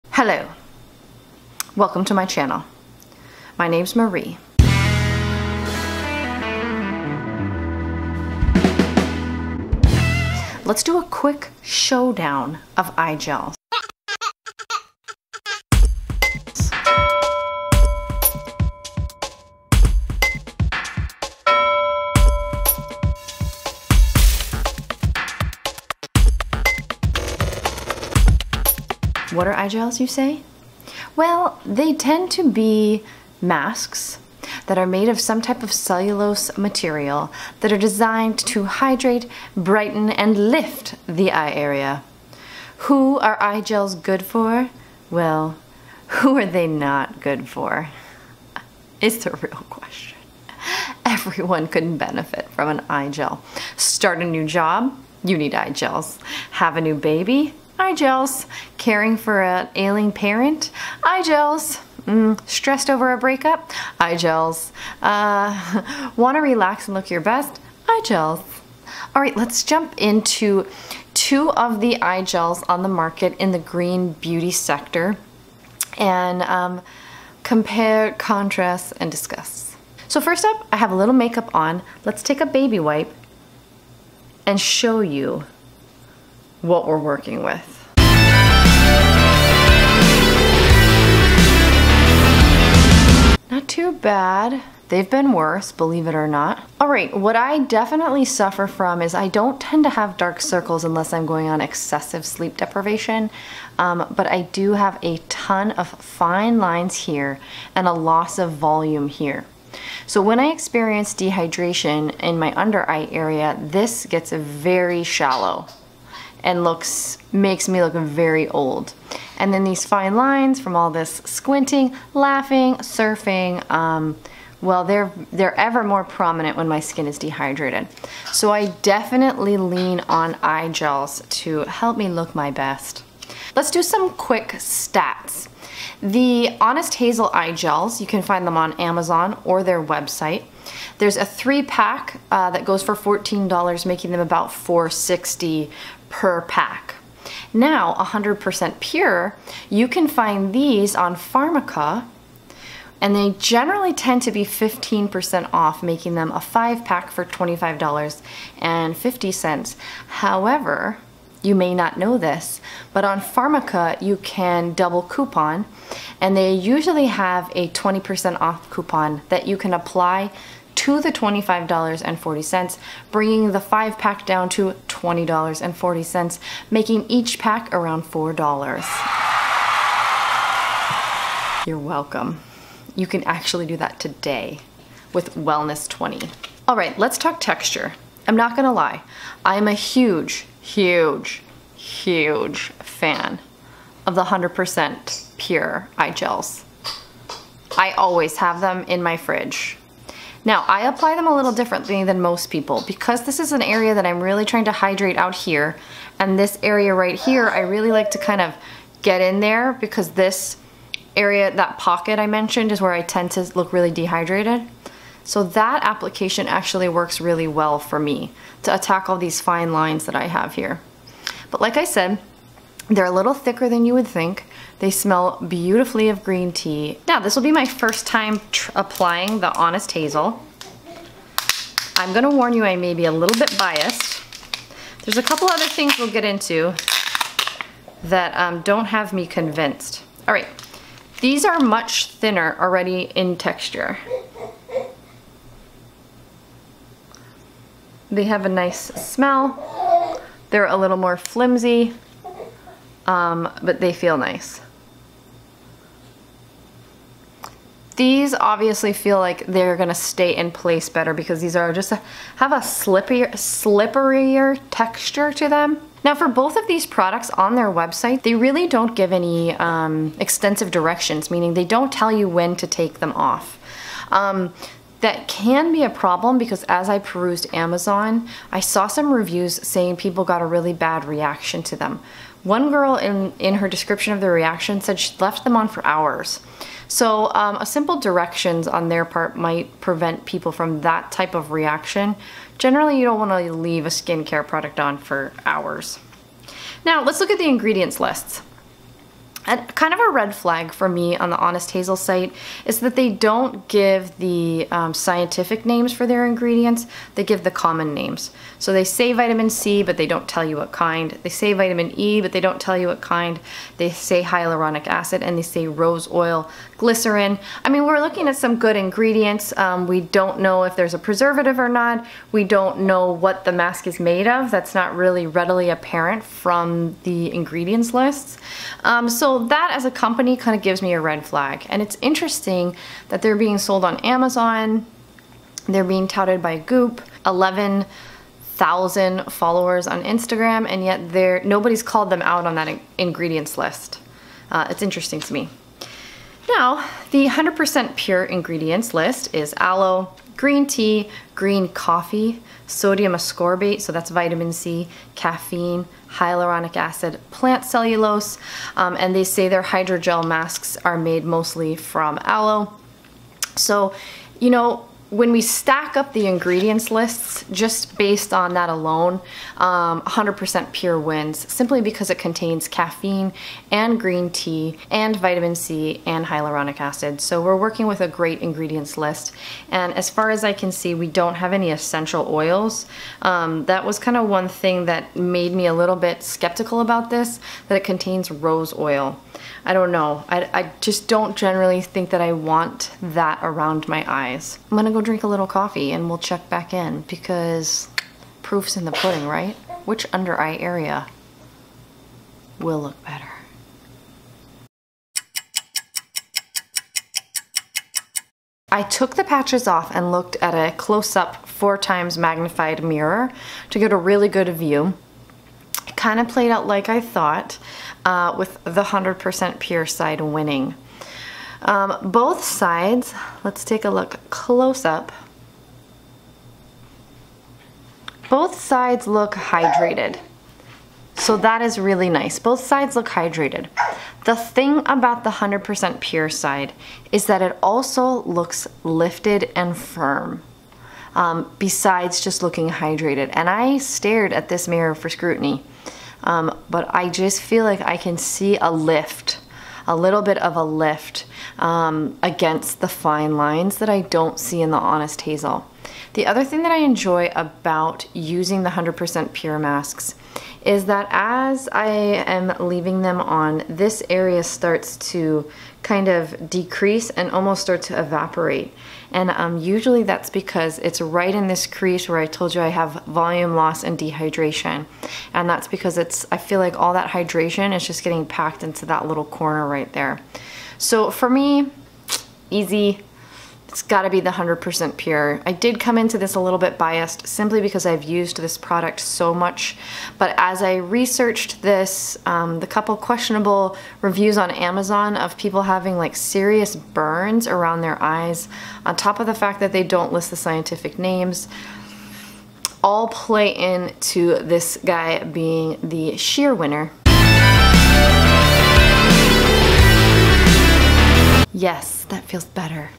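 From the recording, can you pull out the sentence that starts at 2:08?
So I definitely lean on eye gels to help me look my best.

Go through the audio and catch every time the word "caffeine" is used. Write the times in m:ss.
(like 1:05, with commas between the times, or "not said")
5:55, 6:12.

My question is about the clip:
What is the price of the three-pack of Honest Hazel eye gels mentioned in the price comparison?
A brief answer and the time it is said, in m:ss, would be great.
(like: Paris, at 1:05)
$14, at 2:22.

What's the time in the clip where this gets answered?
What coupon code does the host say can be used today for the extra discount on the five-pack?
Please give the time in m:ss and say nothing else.
3:05.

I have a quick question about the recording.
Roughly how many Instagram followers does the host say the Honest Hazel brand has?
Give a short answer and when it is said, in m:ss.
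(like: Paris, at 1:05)
11,000, at 5:37.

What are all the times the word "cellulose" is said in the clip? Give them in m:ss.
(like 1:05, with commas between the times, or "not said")
0:35, 5:57.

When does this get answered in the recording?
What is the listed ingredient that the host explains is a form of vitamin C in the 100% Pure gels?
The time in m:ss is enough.
5:52.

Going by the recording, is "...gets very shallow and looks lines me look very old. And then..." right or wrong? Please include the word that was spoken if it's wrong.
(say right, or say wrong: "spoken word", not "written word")
wrong: "makes", not "lines".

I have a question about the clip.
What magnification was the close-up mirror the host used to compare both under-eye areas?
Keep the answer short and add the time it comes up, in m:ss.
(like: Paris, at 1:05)
4 times, at 6:51.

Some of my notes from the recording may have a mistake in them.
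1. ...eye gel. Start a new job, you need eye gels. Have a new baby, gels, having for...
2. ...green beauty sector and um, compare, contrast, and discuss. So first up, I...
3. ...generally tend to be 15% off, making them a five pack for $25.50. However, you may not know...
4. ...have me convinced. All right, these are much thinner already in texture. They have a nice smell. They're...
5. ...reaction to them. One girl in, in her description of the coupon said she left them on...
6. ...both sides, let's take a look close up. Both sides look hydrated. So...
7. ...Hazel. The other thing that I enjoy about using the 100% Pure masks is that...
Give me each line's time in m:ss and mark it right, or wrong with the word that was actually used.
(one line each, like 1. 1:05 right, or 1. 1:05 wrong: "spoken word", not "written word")
1. 0:52 wrong: "caring", not "having"
2. 1:13 right
3. 2:33 right
4. 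3:58 right
5. 4:41 wrong: "reaction", not "coupon"
6. 7:02 right
7. 7:35 right.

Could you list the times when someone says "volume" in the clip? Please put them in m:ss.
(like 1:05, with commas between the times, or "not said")
1:48, 7:53.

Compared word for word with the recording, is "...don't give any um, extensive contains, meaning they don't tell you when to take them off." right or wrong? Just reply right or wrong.
wrong.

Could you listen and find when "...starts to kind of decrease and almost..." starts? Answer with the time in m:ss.
7:44.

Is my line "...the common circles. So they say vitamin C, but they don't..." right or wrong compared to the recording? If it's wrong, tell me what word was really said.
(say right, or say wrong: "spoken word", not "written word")
wrong: "names", not "circles".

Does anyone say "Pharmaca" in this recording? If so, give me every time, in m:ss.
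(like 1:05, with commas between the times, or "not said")
2:31, 2:43.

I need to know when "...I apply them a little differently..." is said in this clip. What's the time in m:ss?
3:20.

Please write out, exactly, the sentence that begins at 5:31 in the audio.
And it's interesting that they're being sold on Amazon.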